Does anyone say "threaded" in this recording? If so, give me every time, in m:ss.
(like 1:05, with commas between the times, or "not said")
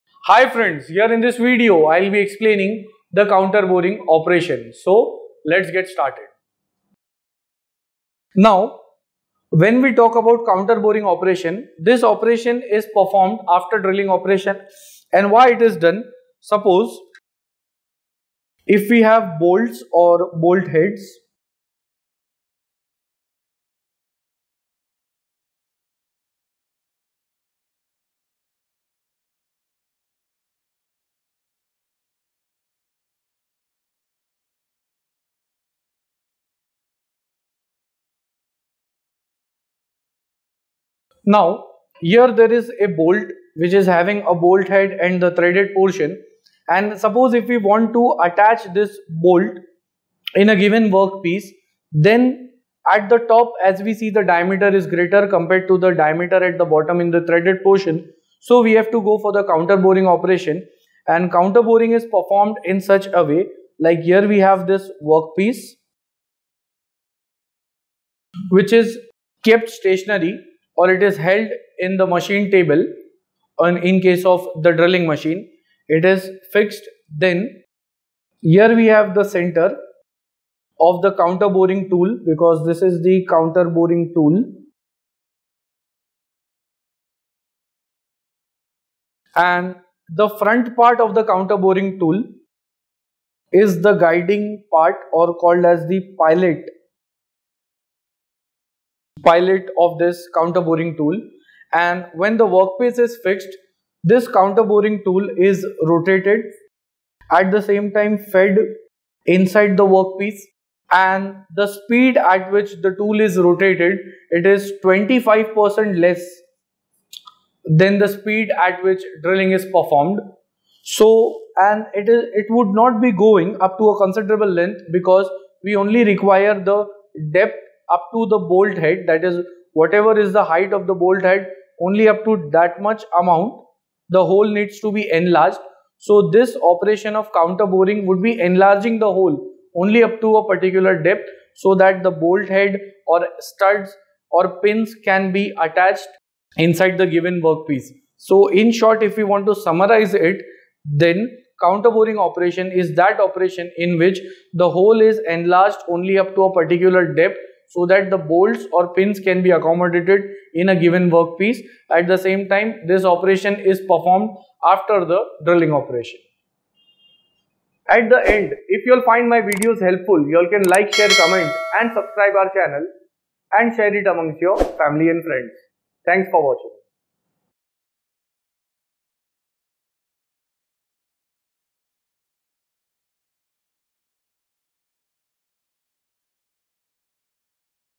0:45, 0:57.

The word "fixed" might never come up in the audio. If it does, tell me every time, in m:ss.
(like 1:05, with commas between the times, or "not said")
1:16, 1:43.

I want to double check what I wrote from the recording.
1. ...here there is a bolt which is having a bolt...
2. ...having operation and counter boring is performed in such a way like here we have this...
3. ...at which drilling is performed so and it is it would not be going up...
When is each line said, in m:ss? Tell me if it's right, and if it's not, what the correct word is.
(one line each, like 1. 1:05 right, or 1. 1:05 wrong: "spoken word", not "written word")
1. 0:41 right
2. 0:59 wrong: "boring", not "having"
3. 1:58 right.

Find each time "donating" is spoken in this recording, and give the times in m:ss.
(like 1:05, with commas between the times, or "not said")
not said.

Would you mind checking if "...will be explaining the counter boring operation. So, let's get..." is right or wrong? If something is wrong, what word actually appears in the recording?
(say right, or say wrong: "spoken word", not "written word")
right.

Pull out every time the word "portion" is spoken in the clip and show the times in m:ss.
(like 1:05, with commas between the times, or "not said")
0:45, 0:57.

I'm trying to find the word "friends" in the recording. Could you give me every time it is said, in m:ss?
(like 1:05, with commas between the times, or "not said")
0:00, 2:55.